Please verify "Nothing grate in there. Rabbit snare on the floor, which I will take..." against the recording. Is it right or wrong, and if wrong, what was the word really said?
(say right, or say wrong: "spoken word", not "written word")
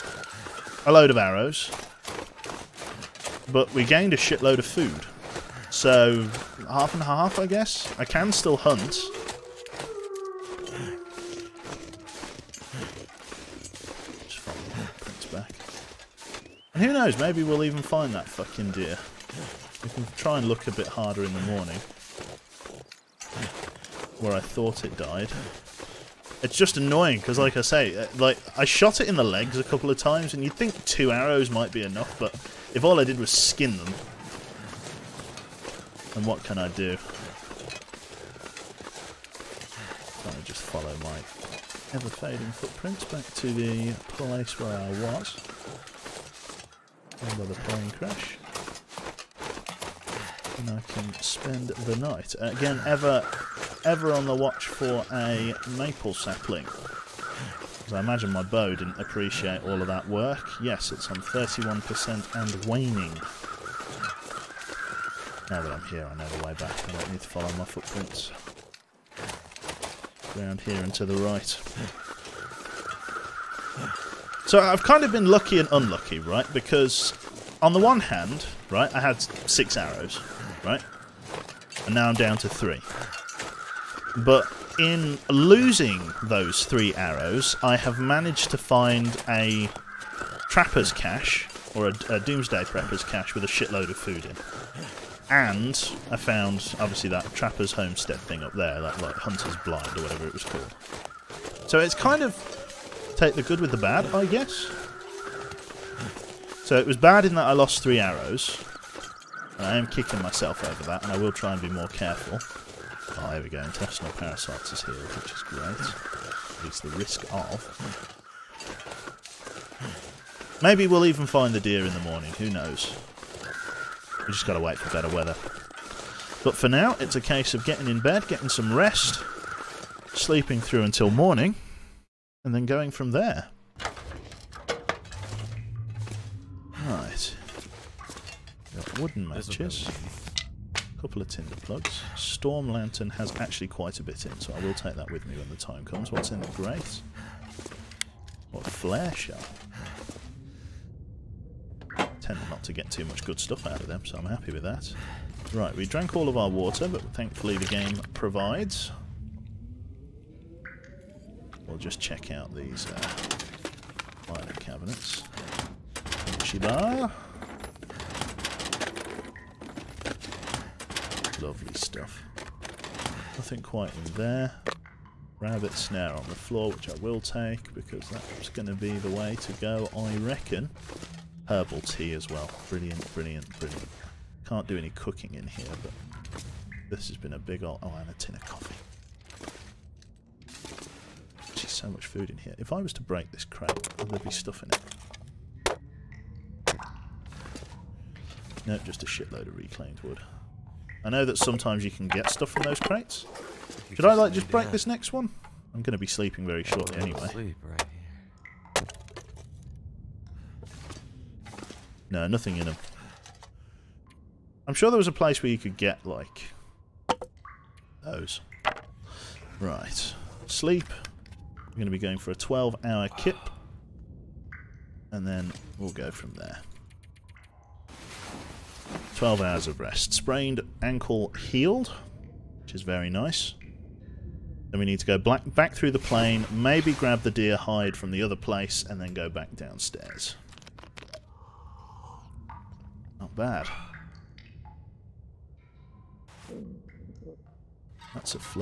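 wrong: "quite", not "grate".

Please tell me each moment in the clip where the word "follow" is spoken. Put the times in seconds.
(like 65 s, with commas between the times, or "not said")
14 s, 40 s, 67 s.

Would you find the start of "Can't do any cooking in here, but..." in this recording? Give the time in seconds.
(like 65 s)
184 s.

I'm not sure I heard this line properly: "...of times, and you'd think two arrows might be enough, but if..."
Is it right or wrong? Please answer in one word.
right.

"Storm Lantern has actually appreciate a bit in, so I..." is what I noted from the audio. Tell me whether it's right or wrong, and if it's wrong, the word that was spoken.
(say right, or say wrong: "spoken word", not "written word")
wrong: "quite", not "appreciate".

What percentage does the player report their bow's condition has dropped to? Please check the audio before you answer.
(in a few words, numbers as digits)
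31%.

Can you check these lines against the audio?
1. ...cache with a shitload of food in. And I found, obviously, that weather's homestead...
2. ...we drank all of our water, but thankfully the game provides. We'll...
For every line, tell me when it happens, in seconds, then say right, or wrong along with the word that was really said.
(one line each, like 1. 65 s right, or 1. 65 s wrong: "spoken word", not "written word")
1. 93 s wrong: "trapper", not "weather"
2. 155 s right.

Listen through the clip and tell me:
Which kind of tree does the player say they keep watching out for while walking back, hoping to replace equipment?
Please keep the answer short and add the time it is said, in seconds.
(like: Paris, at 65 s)
maple sapling, at 55 s.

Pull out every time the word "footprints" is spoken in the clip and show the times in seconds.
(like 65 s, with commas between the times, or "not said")
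42 s, 67 s.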